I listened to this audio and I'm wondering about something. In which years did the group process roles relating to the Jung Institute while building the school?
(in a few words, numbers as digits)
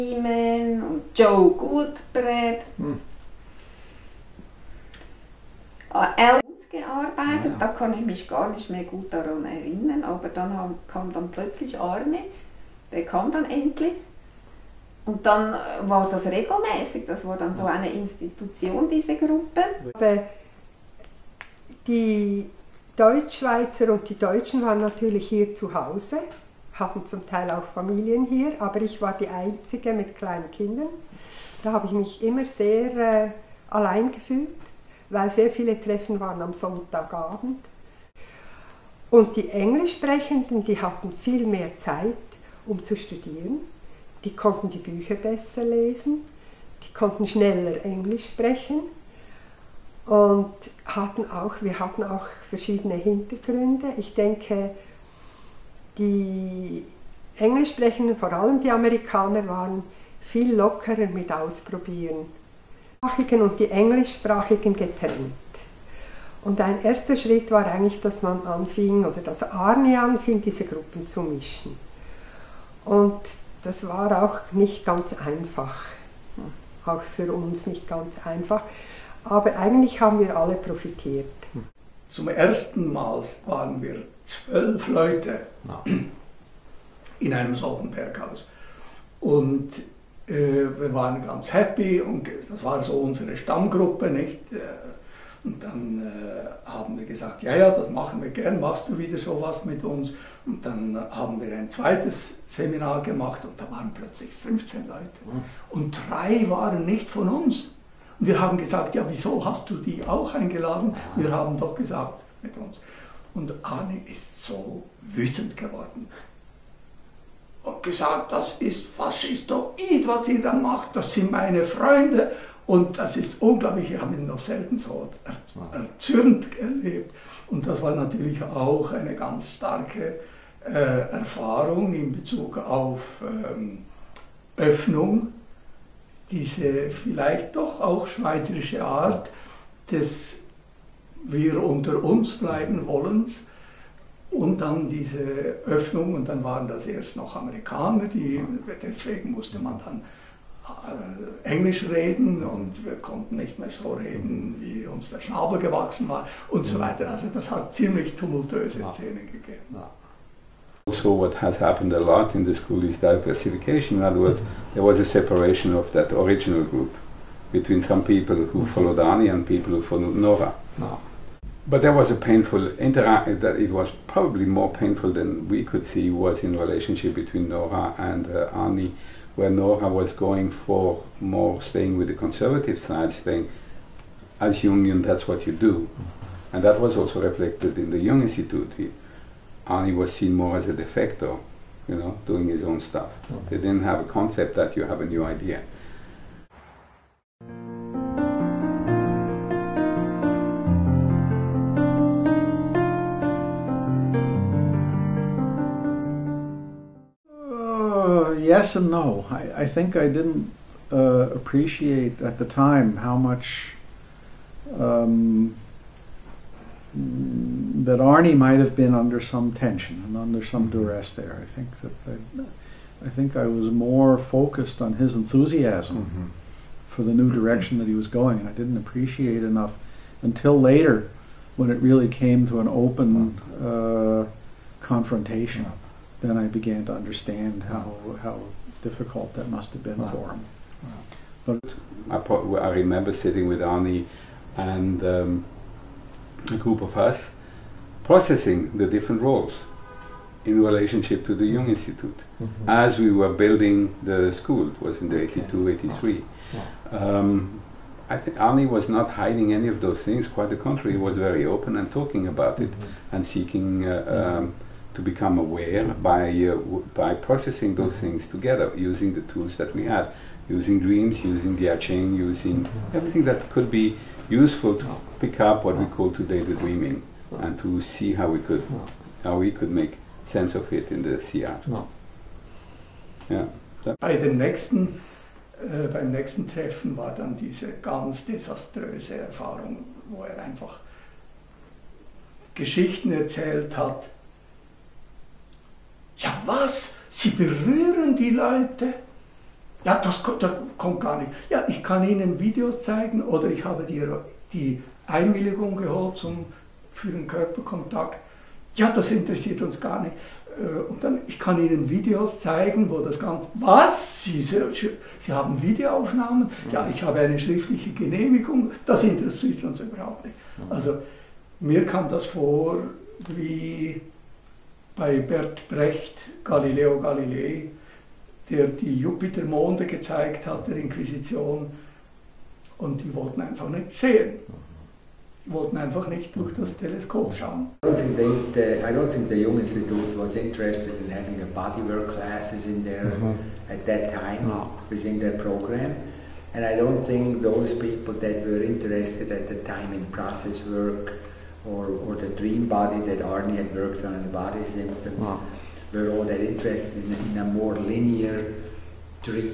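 82, 83.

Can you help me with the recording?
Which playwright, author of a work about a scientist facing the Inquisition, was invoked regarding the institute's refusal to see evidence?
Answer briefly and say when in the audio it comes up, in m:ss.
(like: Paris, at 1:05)
Bert Brecht, at 5:25.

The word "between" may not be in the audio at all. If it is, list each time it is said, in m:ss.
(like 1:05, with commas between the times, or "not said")
2:47, 2:57.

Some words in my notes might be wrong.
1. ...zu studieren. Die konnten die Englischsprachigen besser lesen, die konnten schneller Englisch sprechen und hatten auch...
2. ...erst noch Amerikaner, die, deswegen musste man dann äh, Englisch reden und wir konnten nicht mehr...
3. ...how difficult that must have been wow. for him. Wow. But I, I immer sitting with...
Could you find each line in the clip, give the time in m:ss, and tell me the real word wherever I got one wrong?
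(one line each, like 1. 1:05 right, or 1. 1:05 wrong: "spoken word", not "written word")
1. 0:42 wrong: "Bücher", not "Englischsprachigen"
2. 2:26 right
3. 3:58 wrong: "remember", not "immer".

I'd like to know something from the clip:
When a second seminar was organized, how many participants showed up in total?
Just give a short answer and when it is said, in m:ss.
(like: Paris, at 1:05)
15, at 1:44.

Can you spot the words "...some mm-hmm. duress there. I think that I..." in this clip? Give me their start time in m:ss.
3:40.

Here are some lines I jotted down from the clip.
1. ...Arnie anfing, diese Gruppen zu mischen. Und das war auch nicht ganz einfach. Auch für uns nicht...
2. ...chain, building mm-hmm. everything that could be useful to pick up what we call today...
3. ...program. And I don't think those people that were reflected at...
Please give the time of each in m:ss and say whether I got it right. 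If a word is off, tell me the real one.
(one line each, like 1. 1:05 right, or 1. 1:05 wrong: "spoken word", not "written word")
1. 1:09 right
2. 4:31 wrong: "using", not "building"
3. 5:45 wrong: "interested", not "reflected".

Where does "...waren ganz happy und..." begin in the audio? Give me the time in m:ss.
1:30.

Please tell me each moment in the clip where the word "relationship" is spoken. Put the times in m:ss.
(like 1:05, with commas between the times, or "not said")
2:56, 4:10.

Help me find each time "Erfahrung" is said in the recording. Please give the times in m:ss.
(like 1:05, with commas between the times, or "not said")
2:10, 4:49.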